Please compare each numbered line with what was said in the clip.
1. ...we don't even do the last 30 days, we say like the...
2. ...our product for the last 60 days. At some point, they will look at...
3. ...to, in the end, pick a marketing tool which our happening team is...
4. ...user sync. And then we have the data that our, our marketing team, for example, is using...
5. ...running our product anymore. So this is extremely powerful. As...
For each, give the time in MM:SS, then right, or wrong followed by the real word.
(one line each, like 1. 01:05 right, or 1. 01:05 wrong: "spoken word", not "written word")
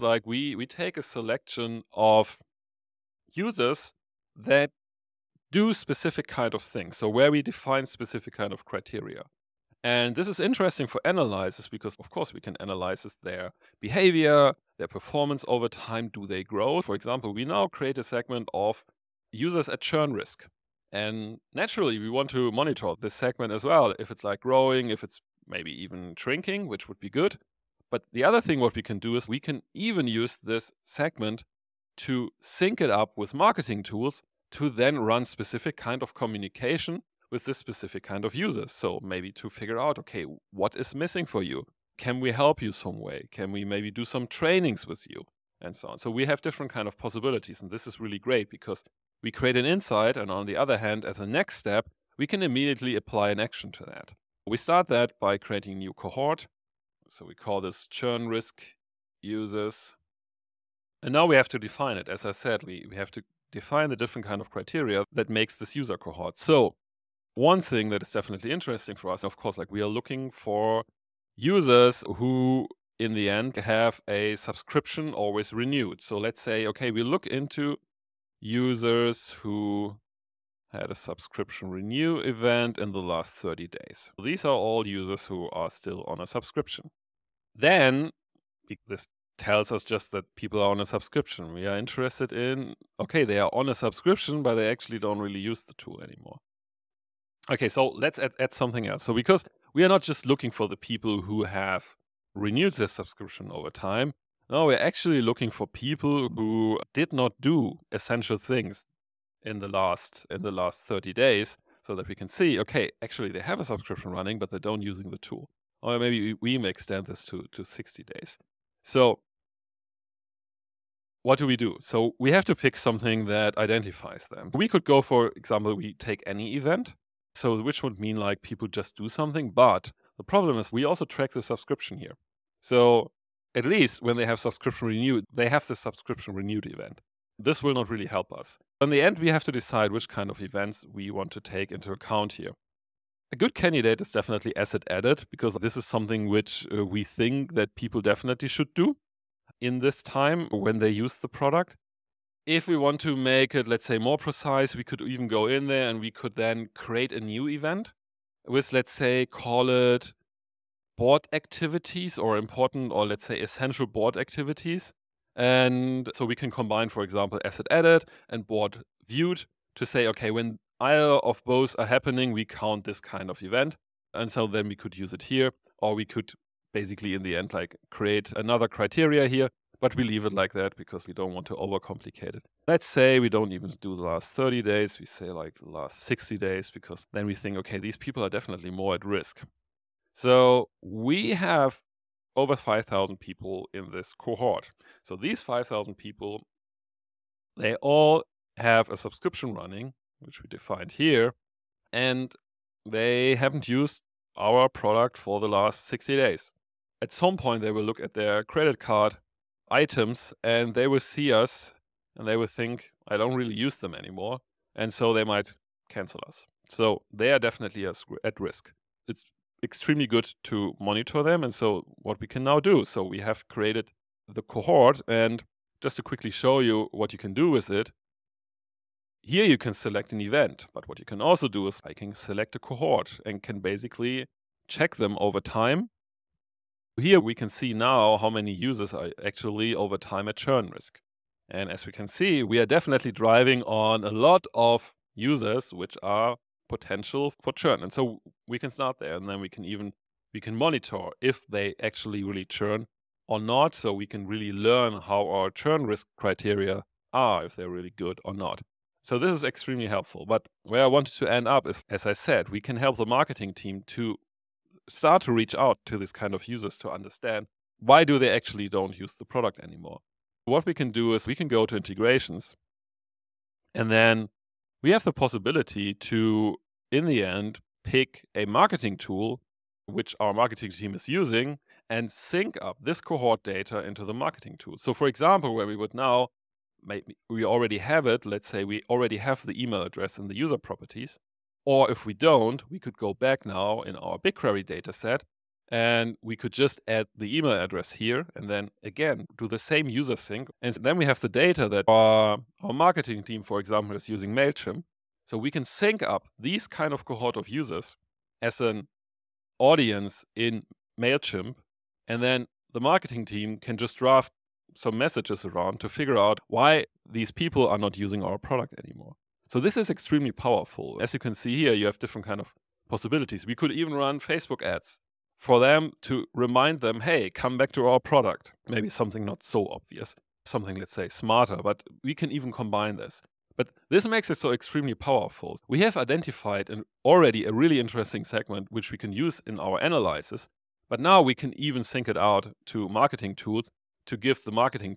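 1. 03:03 right
2. 03:24 right
3. 04:35 wrong: "marketing", not "happening"
4. 04:59 right
5. 05:17 wrong: "using", not "running".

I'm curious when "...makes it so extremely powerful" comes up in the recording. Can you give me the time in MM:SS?
05:34.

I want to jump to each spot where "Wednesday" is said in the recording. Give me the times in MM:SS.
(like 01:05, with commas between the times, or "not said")
not said.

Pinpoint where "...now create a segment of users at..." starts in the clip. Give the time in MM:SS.
00:17.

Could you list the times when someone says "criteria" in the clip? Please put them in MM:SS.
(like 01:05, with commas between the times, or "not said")
00:08, 01:04, 02:58, 04:16.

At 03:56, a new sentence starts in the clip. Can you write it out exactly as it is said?
Here we can see now how many users are actually over time at churn risk.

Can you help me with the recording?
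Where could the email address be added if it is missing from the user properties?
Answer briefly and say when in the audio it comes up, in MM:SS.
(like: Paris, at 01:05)
BigQuery dataset, at 04:54.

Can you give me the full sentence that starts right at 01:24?
These are all users who are still on a subscription.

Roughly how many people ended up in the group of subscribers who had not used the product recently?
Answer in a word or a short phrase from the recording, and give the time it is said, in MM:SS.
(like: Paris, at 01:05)
over 5,000, at 03:12.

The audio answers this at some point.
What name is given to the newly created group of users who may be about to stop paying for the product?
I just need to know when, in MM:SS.
00:57.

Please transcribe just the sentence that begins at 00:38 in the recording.
So maybe to figure out, okay, what is missing for you?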